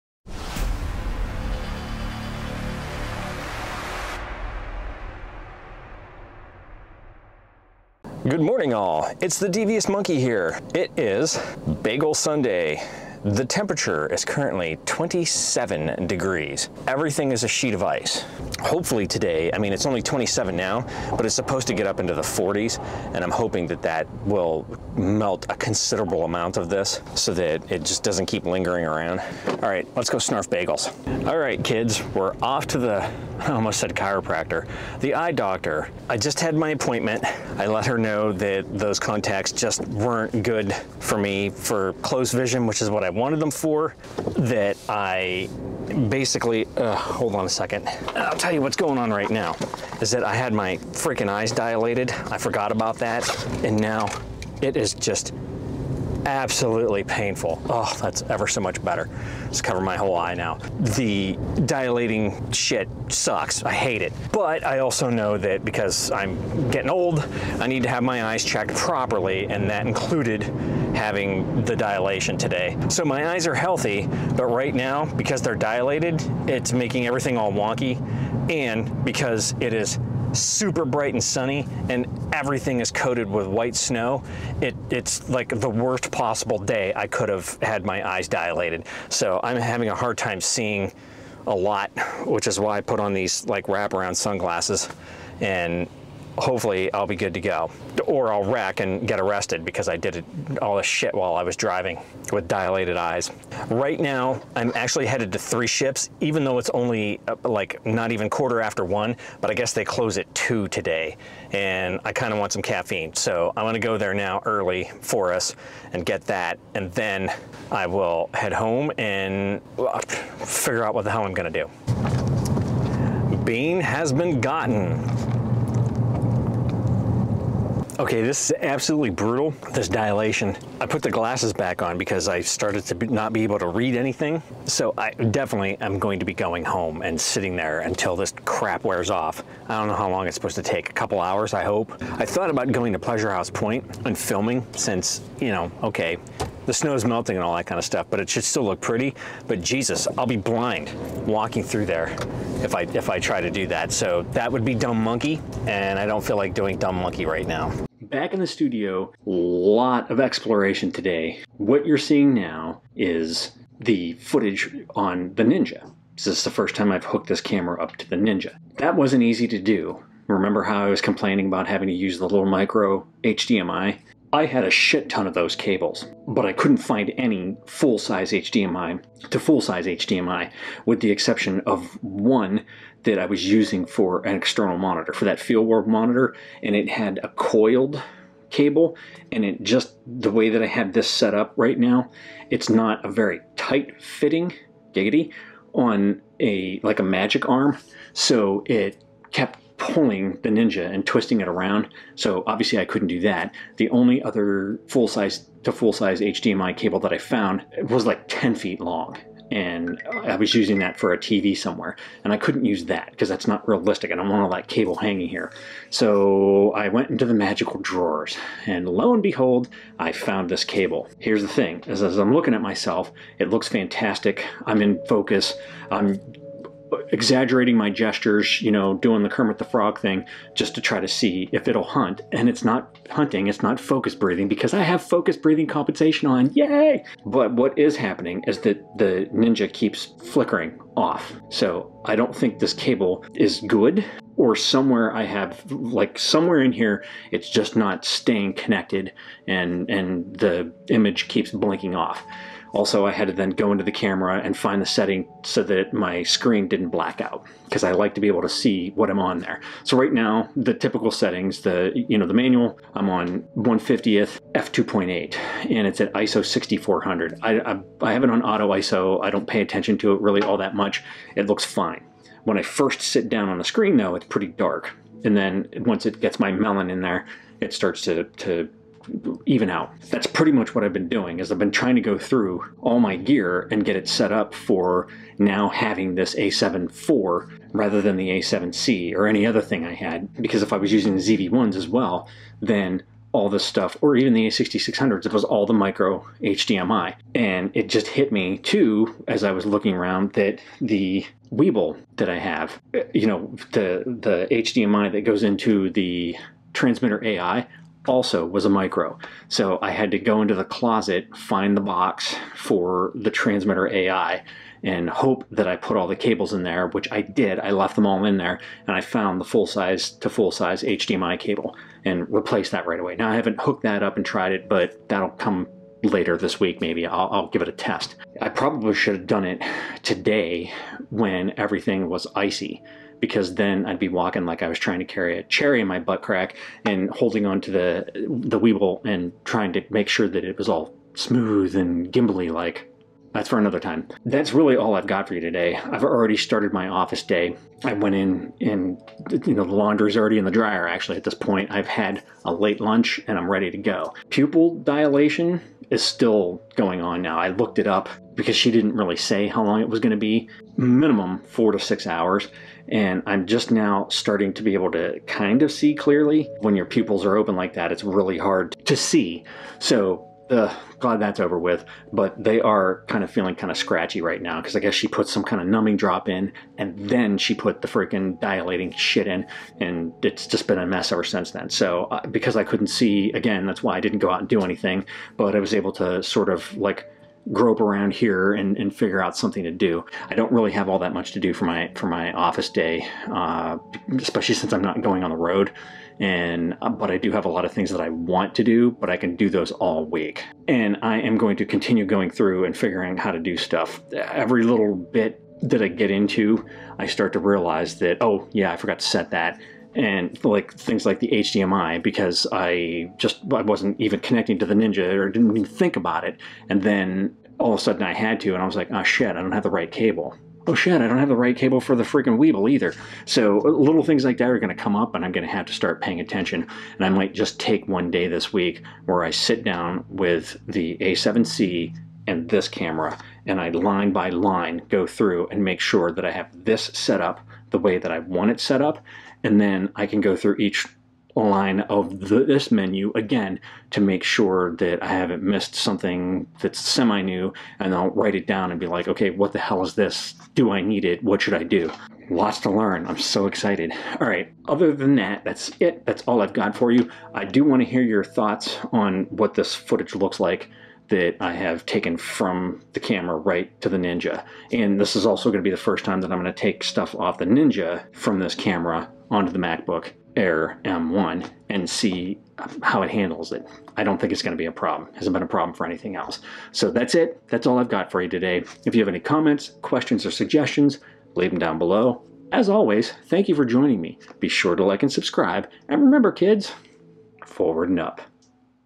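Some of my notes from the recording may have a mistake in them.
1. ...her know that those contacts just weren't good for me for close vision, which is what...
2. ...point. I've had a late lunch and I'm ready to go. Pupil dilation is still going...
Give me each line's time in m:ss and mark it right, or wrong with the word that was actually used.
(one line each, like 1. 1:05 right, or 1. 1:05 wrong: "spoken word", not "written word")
1. 0:37 right
2. 5:51 right.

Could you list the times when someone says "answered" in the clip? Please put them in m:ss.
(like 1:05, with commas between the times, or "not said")
not said.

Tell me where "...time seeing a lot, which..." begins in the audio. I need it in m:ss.
1:30.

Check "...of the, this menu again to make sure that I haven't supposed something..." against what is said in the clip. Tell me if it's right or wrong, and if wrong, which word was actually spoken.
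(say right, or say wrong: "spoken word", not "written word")
wrong: "missed", not "supposed".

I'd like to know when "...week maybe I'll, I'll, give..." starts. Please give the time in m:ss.
5:26.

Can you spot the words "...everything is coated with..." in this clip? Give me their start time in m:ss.
1:22.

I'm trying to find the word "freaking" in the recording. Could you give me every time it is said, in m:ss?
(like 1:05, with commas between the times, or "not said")
0:50, 6:17, 7:02.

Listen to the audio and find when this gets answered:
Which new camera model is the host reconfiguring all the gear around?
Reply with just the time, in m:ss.
4:46.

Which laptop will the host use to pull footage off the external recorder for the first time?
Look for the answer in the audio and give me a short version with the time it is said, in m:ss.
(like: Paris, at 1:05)
MacBook Air M1, at 7:49.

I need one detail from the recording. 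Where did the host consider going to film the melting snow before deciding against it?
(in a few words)
Pleasure House Point.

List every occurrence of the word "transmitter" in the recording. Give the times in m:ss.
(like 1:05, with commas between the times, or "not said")
5:06, 5:13.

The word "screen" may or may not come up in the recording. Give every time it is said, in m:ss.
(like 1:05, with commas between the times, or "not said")
4:16, 4:33.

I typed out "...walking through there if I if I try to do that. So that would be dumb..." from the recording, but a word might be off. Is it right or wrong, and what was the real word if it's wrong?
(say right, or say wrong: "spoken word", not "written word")
right.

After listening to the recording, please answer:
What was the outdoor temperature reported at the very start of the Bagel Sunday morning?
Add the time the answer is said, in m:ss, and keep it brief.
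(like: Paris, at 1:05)
27 degrees, at 0:14.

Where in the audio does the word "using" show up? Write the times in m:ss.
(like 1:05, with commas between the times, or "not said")
3:03, 3:30, 4:50.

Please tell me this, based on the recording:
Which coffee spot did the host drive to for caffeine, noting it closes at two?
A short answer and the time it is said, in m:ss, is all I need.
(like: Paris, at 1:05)
Three Ships, at 1:45.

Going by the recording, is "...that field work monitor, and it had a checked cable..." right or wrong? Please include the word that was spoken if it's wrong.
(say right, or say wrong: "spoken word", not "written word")
wrong: "coiled", not "checked".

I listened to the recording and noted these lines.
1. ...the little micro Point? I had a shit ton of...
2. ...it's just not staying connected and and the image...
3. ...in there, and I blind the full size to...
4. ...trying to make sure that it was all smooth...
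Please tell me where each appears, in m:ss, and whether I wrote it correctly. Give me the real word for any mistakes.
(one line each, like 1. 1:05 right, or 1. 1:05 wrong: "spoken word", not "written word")
1. 2:52 wrong: "HDMI", not "Point"
2. 4:07 right
3. 5:18 wrong: "found", not "blind"
4. 5:39 right.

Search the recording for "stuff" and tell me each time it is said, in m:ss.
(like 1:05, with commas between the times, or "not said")
2:27, 4:53, 6:43, 7:46.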